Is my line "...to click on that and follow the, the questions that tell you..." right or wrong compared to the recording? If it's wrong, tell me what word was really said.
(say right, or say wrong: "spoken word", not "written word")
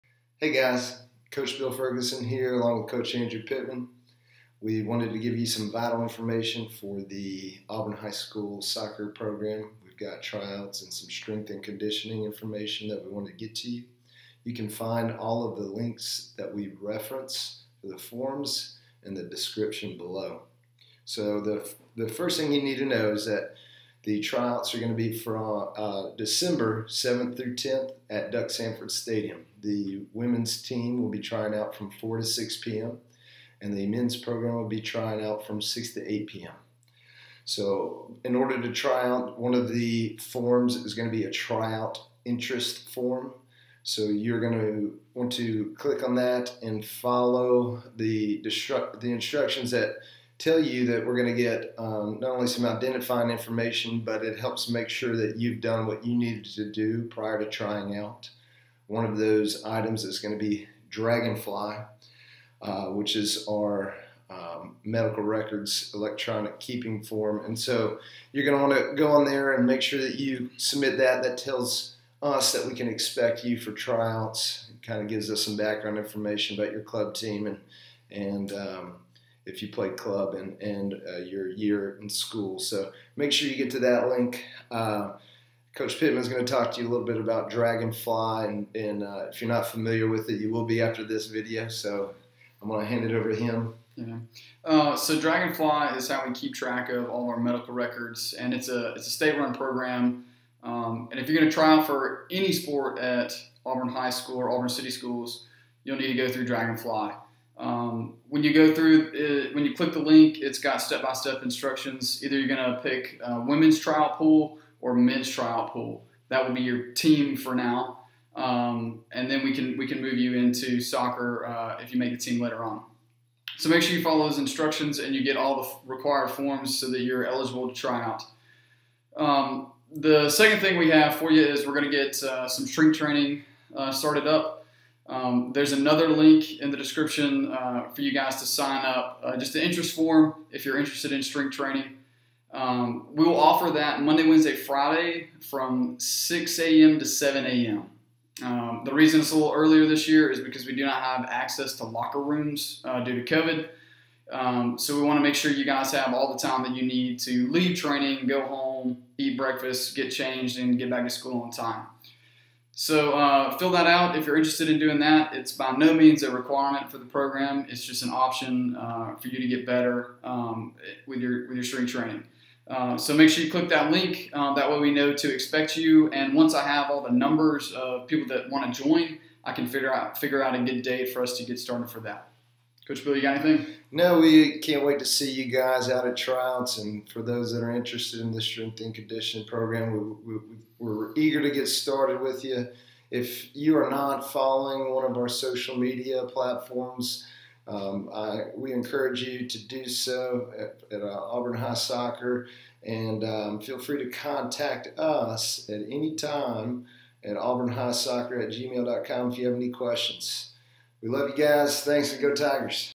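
wrong: "instructions", not "questions".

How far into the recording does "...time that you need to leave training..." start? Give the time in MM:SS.
02:36.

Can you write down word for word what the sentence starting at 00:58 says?
One of those items is going to be Dragonfly, uh, which is our um, medical records electronic keeping form.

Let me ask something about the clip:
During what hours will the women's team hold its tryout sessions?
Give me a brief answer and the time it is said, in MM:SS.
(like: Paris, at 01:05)
4 to 6 p.m., at 00:31.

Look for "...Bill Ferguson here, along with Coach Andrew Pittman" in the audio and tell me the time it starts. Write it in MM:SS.
00:01.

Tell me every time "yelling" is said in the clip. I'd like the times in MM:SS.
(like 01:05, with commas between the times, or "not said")
not said.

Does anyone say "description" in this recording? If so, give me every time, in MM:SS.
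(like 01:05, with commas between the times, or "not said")
00:19, 02:16.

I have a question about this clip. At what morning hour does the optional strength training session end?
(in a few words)
7 a.m.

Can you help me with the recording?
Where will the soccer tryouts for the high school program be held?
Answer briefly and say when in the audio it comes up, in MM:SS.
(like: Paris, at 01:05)
Duck Samford Stadium, at 00:28.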